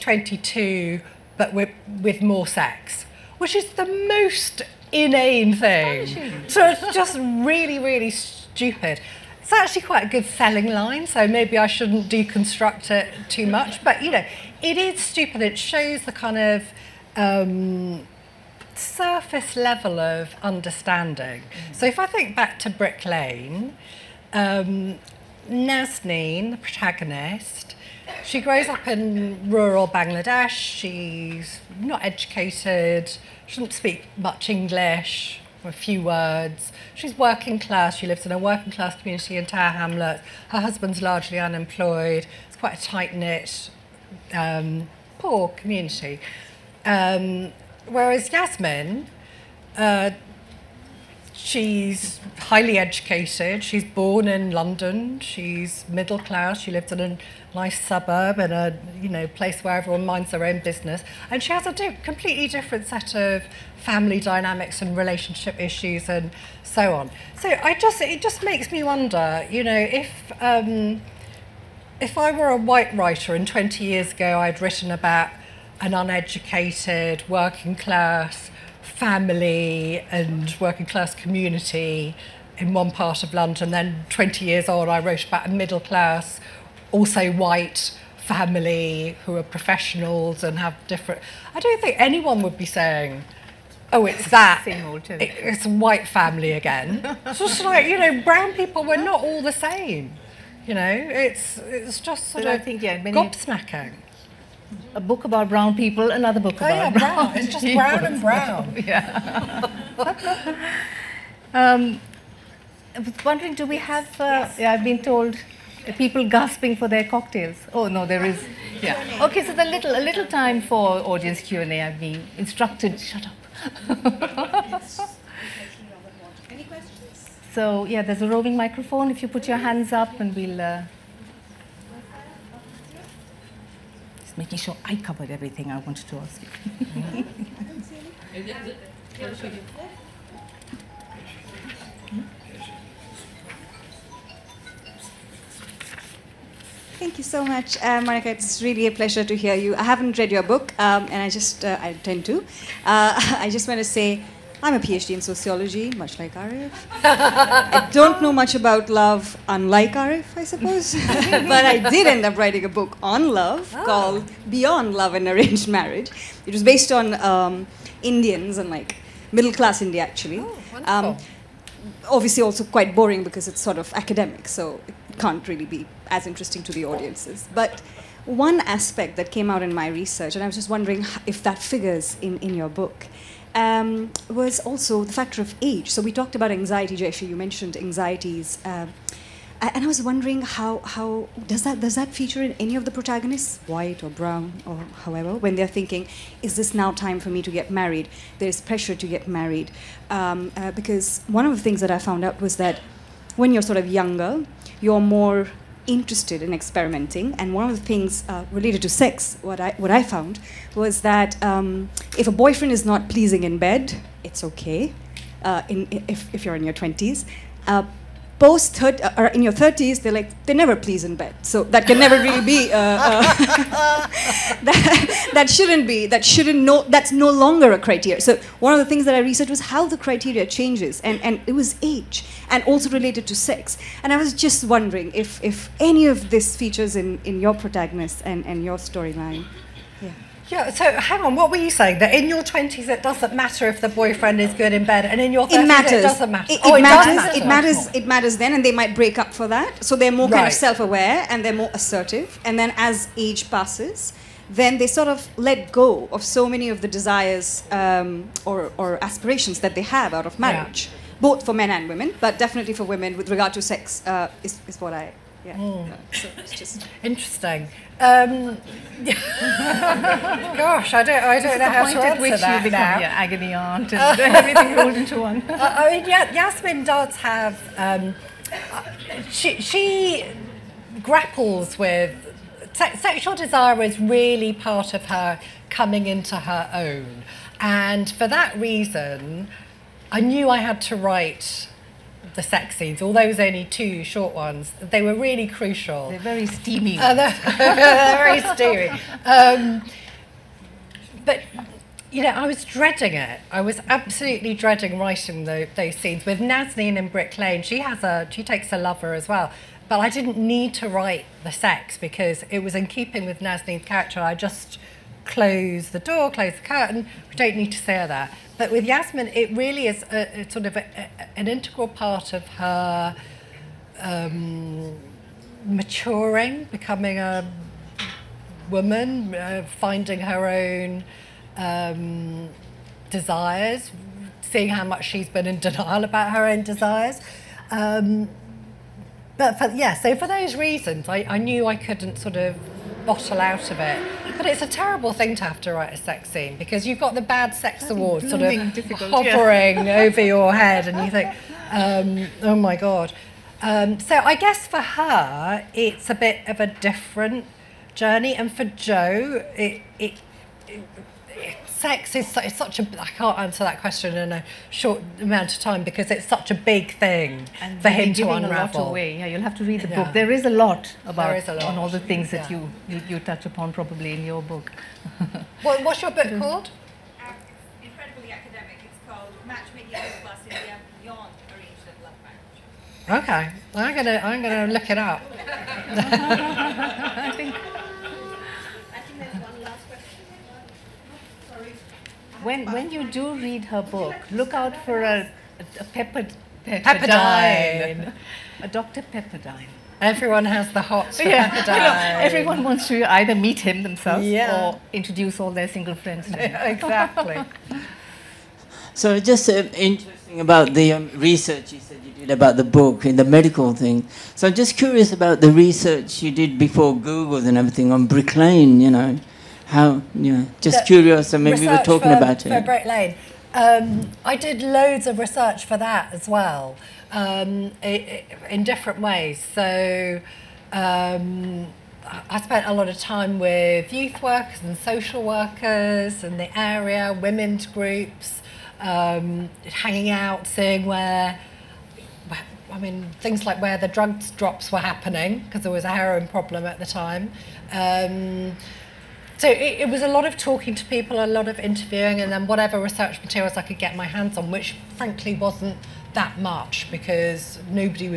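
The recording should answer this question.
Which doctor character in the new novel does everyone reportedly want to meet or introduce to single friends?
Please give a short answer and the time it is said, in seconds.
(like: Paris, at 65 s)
Dr. Pepperdine, at 398 s.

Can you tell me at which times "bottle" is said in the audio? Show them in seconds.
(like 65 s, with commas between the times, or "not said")
343 s.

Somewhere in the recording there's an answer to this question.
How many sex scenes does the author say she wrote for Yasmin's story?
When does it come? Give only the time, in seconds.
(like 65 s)
293 s.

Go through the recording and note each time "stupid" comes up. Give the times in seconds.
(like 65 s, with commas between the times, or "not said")
8 s, 15 s.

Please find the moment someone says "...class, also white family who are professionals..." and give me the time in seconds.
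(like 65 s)
85 s.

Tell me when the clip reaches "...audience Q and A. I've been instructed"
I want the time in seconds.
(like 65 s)
121 s.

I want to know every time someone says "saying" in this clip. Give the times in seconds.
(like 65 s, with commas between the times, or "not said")
92 s, 241 s.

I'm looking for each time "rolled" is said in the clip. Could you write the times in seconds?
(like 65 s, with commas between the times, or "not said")
274 s.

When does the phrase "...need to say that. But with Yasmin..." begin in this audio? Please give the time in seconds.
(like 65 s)
317 s.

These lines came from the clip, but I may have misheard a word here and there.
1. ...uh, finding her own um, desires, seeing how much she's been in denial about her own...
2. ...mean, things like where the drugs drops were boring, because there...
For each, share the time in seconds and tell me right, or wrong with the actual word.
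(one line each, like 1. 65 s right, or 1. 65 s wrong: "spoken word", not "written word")
1. 329 s right
2. 442 s wrong: "happening", not "boring".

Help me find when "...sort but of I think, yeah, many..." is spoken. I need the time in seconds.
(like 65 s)
102 s.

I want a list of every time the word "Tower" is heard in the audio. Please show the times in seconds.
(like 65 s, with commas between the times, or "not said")
39 s.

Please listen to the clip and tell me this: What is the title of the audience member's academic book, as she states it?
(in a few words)
Matchmaking Plus Beyond Arranged Love Marriage.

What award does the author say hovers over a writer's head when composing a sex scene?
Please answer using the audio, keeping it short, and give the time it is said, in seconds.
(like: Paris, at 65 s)
Bad Sex Award, at 347 s.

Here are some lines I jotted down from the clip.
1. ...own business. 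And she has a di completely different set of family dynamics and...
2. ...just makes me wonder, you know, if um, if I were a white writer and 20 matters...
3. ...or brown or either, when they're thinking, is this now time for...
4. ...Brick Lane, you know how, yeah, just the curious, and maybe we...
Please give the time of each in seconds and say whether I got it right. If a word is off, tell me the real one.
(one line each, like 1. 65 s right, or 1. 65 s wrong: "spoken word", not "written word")
1. 60 s right
2. 68 s wrong: "years", not "matters"
3. 194 s wrong: "however", not "either"
4. 418 s right.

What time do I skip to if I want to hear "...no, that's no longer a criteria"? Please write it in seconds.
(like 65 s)
226 s.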